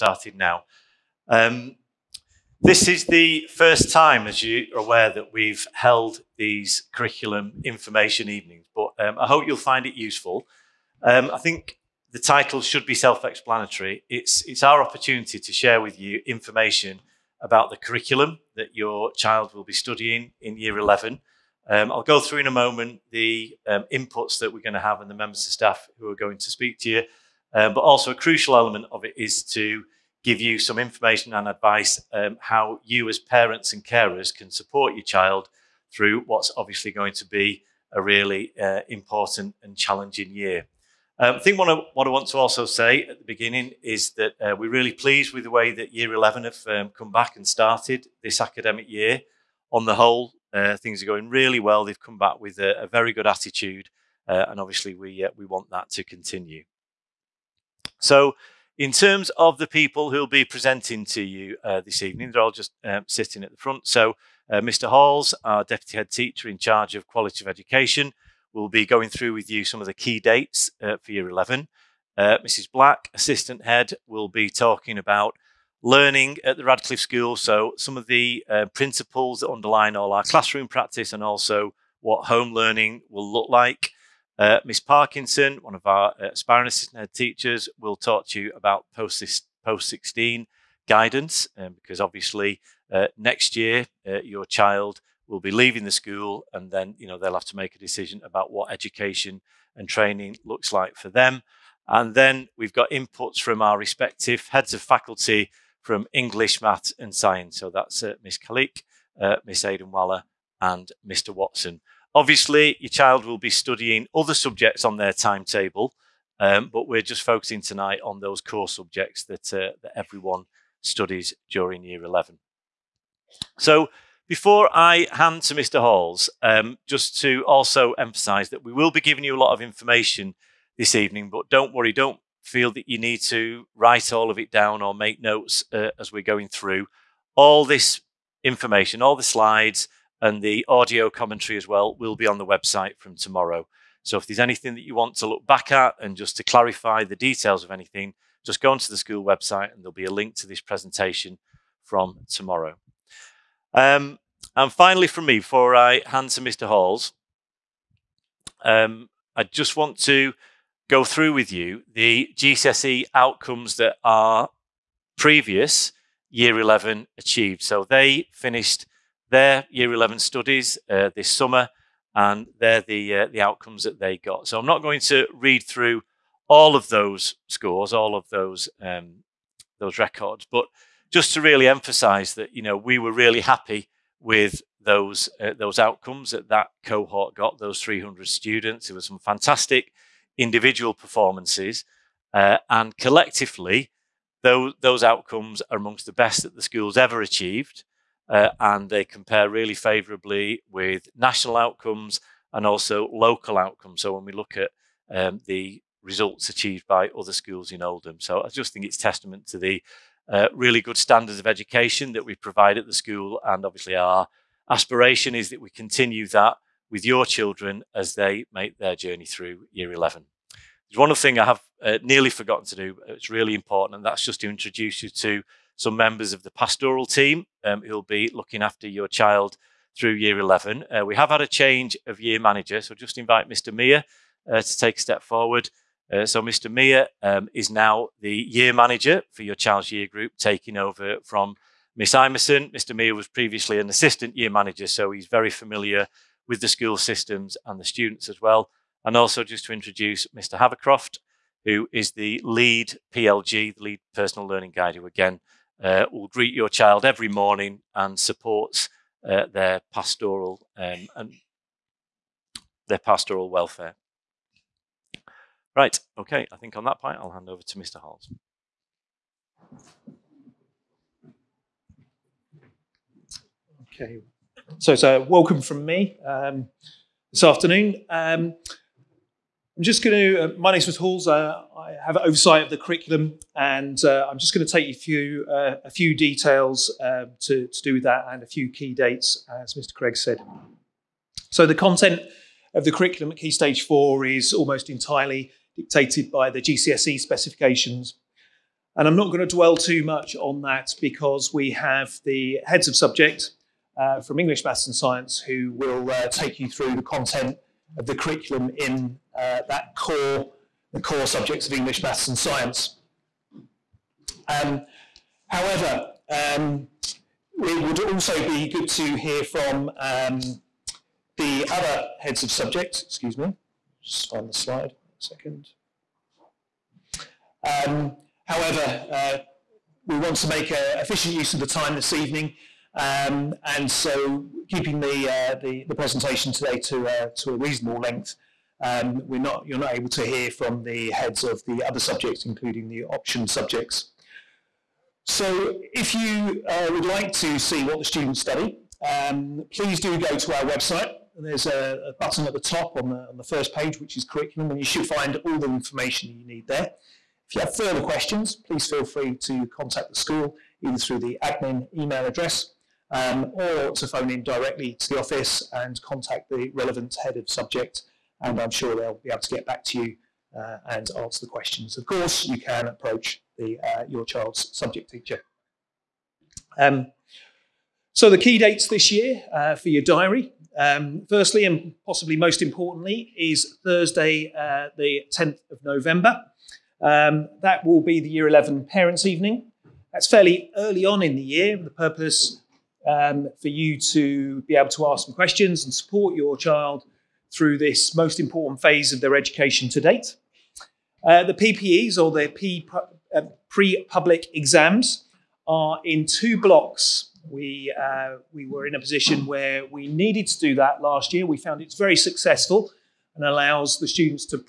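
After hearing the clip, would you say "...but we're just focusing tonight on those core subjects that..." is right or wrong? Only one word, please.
right.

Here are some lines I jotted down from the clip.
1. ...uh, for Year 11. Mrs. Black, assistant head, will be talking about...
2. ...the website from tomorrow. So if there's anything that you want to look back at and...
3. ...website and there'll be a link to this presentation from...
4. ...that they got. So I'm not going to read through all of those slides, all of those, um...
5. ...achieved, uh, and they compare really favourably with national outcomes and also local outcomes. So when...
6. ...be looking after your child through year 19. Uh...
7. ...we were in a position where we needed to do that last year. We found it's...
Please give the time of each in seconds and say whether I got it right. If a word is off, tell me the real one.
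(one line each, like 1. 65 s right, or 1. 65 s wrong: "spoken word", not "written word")
1. 70 s right
2. 142 s right
3. 149 s right
4. 173 s wrong: "scores", not "slides"
5. 197 s right
6. 228 s wrong: "11", not "19"
7. 408 s right.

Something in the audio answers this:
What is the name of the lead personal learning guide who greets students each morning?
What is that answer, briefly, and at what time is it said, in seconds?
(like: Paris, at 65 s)
Mr. Havercroft, at 250 s.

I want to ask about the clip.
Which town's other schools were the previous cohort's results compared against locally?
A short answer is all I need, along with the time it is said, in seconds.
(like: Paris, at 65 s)
Oldham, at 207 s.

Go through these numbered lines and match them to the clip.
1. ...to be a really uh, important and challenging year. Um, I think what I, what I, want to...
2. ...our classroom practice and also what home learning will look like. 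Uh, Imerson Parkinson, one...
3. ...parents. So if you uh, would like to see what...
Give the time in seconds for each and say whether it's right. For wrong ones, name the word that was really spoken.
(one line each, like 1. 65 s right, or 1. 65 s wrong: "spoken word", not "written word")
1. 37 s right
2. 80 s wrong: "Miss", not "Imerson"
3. 343 s wrong: "subjects", not "parents".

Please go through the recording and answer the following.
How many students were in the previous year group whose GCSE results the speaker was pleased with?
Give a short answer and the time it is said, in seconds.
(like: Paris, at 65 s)
300, at 187 s.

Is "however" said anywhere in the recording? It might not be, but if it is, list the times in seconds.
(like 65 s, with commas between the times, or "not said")
315 s, 328 s.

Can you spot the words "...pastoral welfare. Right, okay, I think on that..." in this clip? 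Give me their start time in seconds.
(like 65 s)
262 s.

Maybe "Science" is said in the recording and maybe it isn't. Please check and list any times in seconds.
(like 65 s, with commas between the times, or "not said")
107 s, 304 s, 312 s.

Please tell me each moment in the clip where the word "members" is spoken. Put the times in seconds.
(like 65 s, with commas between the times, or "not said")
25 s, 225 s.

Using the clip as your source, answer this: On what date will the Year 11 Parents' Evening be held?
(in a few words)
Thursday 10th November.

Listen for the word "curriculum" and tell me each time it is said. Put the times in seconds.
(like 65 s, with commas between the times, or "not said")
6 s, 17 s, 282 s, 292 s, 308 s, 354 s.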